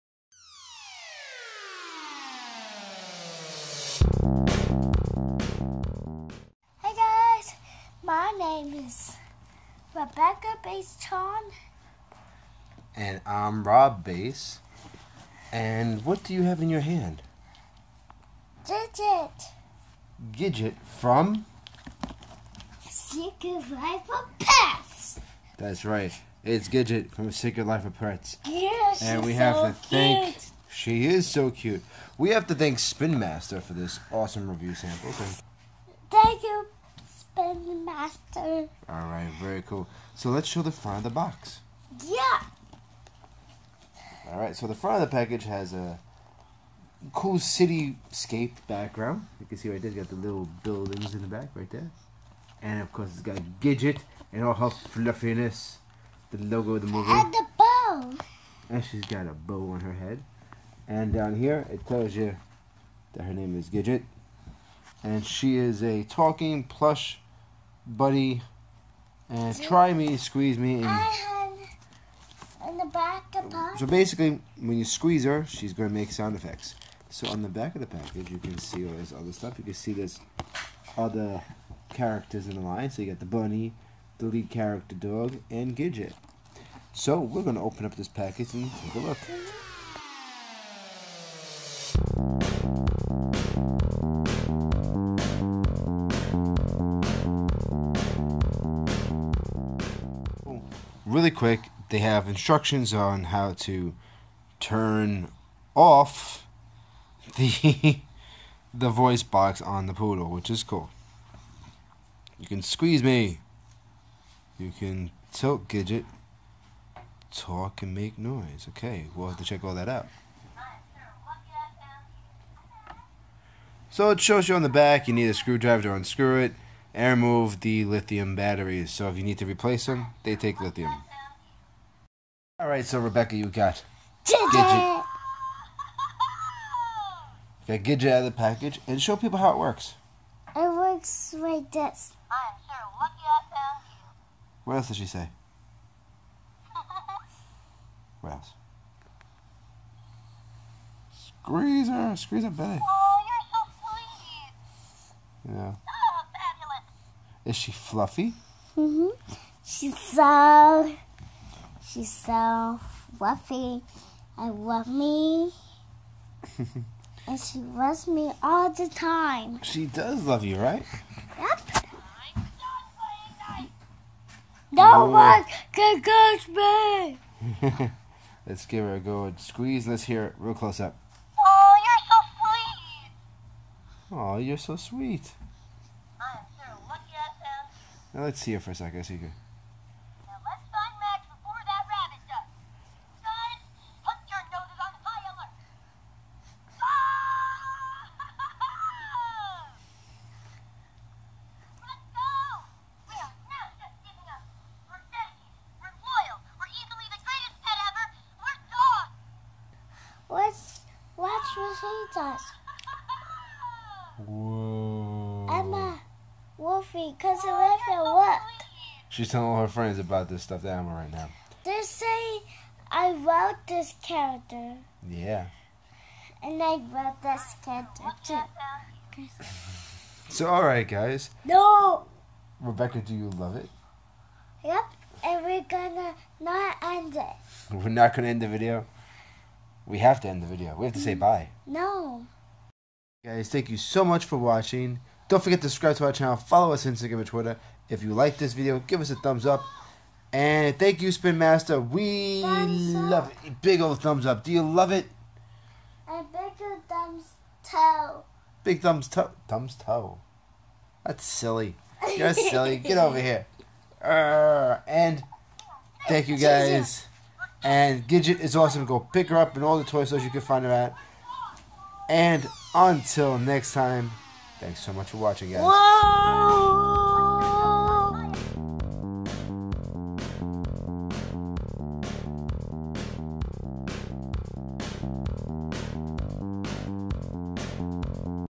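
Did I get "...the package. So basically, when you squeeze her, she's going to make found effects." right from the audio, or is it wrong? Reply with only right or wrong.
wrong.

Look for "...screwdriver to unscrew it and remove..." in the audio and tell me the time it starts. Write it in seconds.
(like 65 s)
125 s.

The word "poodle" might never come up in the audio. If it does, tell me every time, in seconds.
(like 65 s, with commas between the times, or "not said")
109 s.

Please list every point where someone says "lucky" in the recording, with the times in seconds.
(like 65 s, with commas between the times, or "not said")
142 s, 186 s.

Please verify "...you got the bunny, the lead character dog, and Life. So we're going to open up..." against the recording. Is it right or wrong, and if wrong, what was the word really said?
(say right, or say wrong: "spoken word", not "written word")
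wrong: "Gidget", not "Life".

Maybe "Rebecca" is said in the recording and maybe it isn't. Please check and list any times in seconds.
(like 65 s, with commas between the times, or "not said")
9 s, 132 s, 232 s.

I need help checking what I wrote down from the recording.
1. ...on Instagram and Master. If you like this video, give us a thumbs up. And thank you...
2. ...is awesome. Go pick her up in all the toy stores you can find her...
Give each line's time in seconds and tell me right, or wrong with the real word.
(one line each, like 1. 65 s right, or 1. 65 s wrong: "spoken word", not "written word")
1. 246 s wrong: "Twitter", not "Master"
2. 268 s right.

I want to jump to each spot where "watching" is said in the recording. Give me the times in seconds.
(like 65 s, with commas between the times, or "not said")
244 s, 275 s.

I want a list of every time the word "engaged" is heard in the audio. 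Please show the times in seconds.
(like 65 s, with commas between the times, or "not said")
not said.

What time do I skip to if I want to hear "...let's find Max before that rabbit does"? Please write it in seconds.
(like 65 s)
190 s.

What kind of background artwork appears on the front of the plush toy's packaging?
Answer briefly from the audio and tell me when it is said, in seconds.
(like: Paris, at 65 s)
cityscape, at 47 s.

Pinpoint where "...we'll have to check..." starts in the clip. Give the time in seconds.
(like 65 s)
119 s.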